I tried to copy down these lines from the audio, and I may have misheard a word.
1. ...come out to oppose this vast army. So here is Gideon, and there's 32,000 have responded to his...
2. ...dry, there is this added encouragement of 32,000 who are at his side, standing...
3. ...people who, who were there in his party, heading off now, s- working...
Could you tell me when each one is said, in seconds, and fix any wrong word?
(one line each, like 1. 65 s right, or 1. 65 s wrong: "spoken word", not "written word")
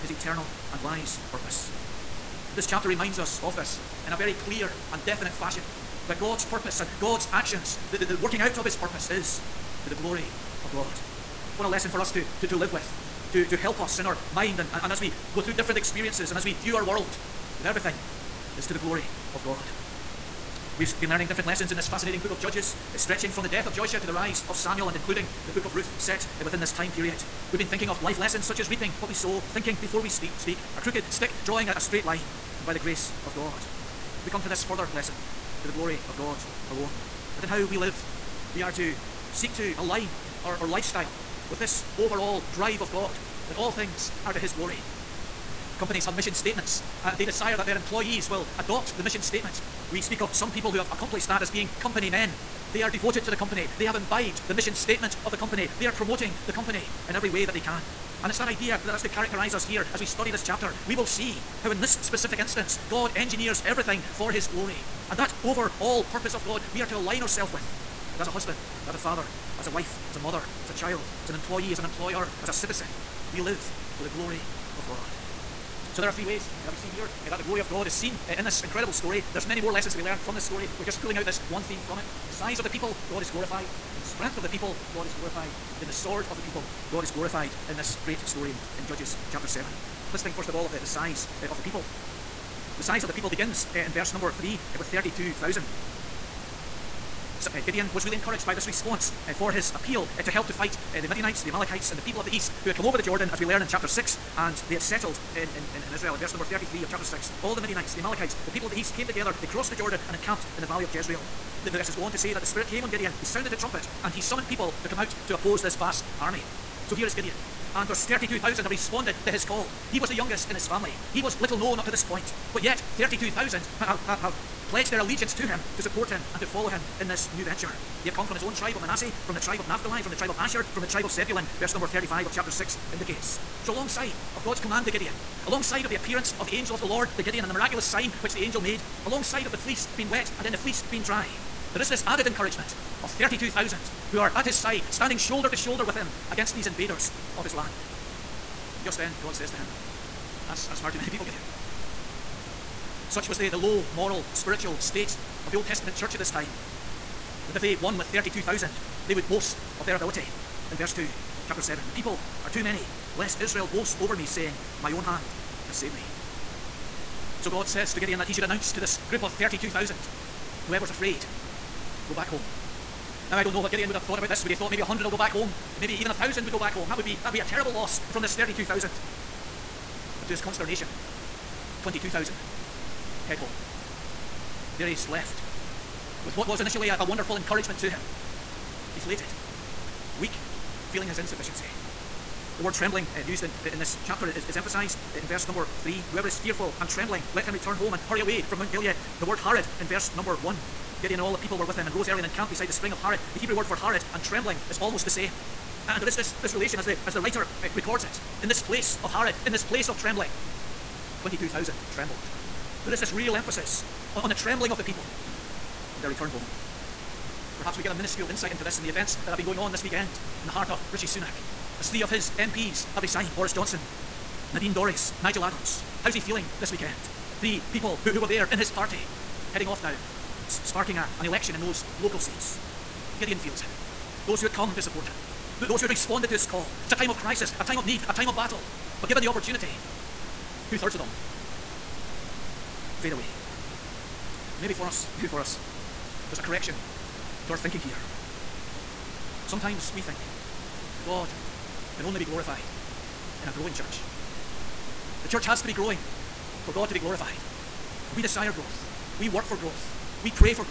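1. 114 s right
2. 141 s right
3. 227 s wrong: "sparking", not "working".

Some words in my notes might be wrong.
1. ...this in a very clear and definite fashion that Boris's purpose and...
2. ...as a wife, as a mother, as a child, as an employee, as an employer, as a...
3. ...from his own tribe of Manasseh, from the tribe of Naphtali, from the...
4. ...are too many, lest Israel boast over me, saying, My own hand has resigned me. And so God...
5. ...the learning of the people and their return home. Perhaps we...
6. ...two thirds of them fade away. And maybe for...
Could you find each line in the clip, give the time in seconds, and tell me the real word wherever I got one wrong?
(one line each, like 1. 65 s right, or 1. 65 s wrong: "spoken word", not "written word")
1. 3 s wrong: "God", not "Boris"
2. 69 s right
3. 128 s right
4. 162 s wrong: "saved", not "resigned"
5. 214 s wrong: "trembling", not "learning"
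6. 240 s right.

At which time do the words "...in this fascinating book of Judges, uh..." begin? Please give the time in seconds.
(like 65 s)
21 s.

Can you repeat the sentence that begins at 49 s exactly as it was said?
We speak of some people who have accomplished that as being company men.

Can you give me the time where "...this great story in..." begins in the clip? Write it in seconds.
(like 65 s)
87 s.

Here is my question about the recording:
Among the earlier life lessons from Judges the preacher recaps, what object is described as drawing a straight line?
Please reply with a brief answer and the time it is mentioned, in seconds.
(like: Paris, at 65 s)
A crooked stick, at 30 s.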